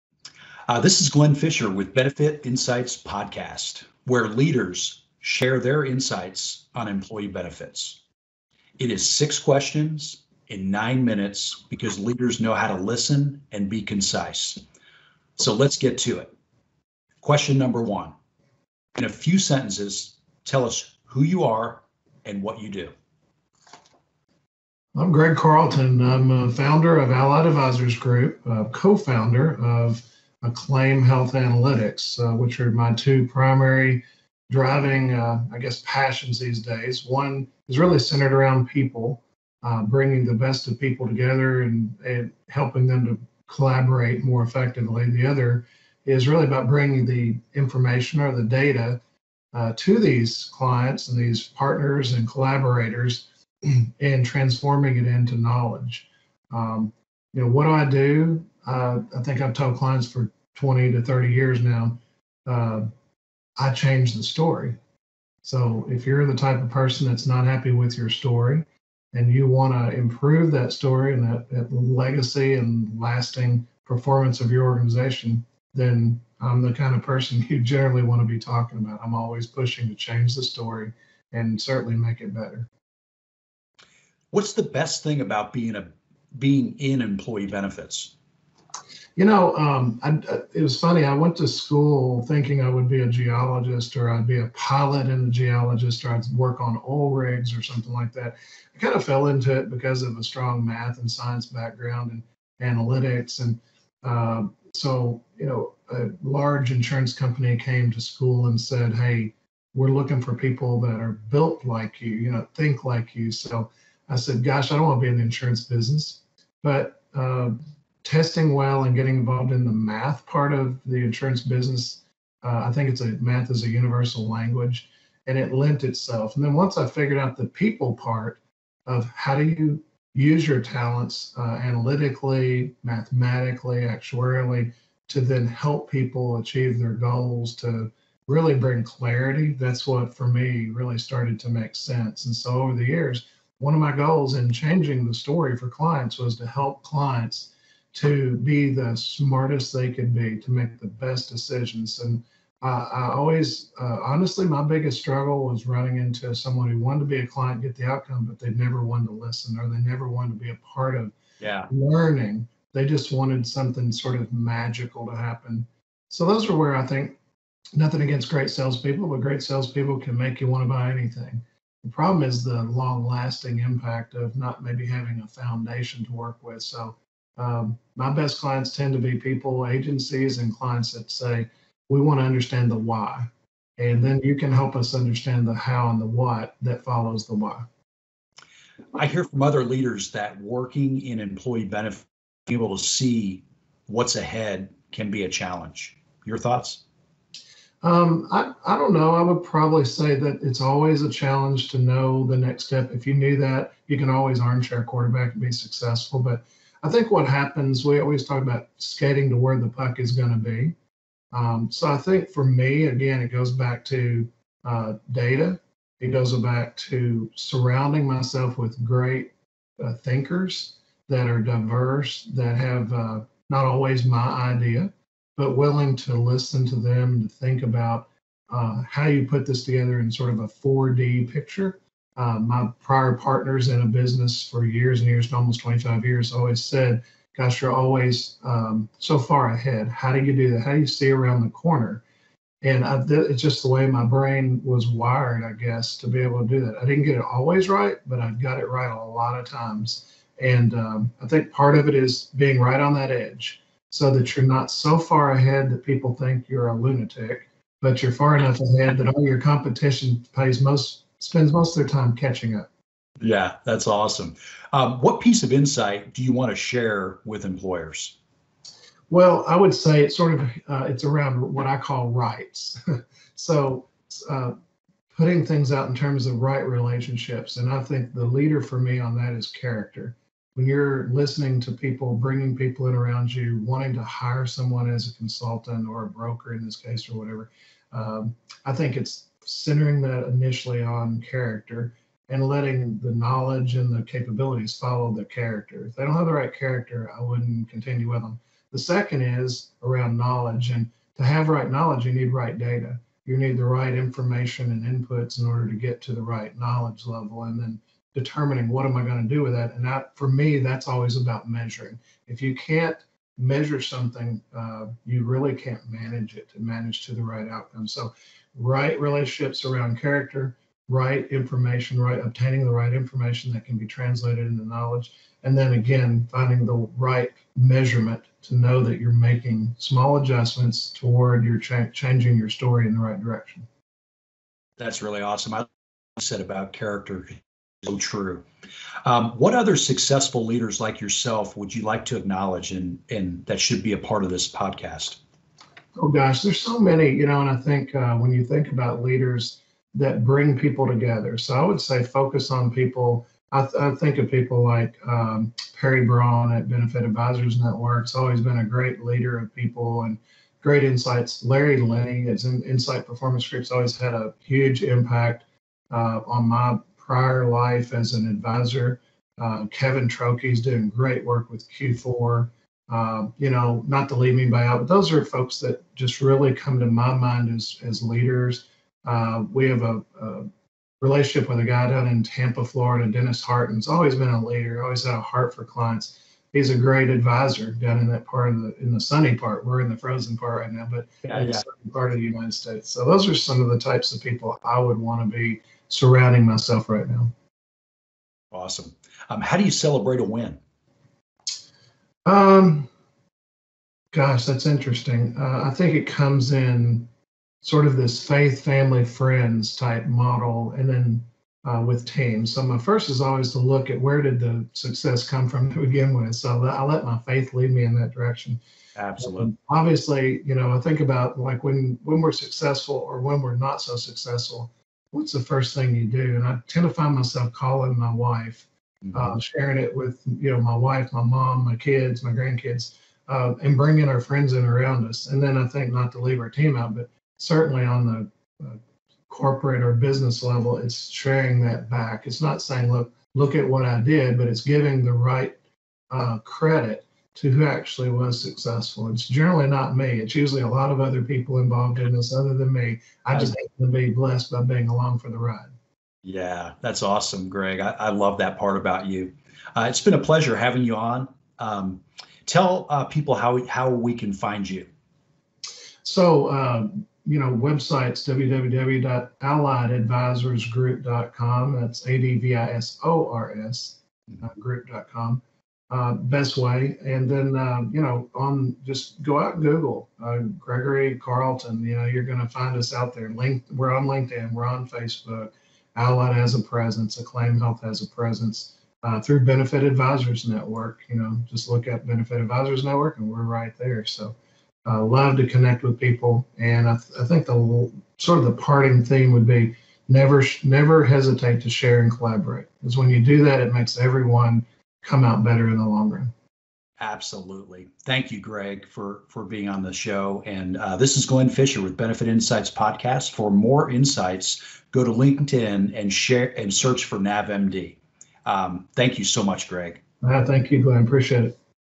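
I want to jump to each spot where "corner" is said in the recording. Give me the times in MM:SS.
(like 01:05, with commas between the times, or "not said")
04:01.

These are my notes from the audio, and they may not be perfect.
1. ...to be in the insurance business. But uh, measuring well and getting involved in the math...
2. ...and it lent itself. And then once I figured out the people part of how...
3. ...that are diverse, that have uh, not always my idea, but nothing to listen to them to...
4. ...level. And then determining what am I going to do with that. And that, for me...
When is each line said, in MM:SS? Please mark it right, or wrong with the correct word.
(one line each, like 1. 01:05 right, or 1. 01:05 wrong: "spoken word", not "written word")
1. 01:54 wrong: "testing", not "measuring"
2. 02:05 right
3. 03:41 wrong: "willing", not "nothing"
4. 05:07 right.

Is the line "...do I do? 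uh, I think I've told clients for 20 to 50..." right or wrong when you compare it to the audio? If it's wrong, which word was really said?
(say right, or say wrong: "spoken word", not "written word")
wrong: "30", not "50".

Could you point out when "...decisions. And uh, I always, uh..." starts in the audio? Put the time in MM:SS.
02:31.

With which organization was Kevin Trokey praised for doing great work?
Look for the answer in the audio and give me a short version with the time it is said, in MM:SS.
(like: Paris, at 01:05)
Q4, at 06:11.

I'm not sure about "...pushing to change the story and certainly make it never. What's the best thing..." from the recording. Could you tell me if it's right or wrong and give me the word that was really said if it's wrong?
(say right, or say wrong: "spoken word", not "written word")
wrong: "better", not "never".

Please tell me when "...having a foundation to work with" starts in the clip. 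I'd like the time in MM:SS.
02:54.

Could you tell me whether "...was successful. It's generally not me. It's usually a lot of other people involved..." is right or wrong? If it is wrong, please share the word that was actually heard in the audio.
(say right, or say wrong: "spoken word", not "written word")
right.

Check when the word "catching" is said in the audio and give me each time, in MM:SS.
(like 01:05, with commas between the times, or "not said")
04:22.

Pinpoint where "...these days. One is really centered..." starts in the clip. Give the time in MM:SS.
00:36.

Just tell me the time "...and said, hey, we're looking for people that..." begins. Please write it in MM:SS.
01:48.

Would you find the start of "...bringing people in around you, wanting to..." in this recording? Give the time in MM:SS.
04:42.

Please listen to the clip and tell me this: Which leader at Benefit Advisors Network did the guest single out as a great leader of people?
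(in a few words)
Perry Braun.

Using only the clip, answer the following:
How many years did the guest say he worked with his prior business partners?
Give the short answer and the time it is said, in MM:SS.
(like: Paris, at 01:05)
25, at 03:55.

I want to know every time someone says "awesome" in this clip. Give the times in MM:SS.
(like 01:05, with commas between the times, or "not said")
04:23, 05:35, 06:38, 07:37.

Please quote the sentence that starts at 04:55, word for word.
If they don't have the right character, I wouldn't continue with them.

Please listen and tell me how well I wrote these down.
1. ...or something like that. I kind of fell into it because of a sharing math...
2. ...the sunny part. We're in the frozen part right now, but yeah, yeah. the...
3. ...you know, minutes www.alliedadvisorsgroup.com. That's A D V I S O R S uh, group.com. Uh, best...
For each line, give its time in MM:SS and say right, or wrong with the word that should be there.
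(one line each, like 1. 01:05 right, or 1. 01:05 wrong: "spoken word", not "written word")
1. 01:37 wrong: "strong", not "sharing"
2. 06:28 right
3. 07:47 wrong: "websites", not "minutes".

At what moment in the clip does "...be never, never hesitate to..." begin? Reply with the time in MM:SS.
08:19.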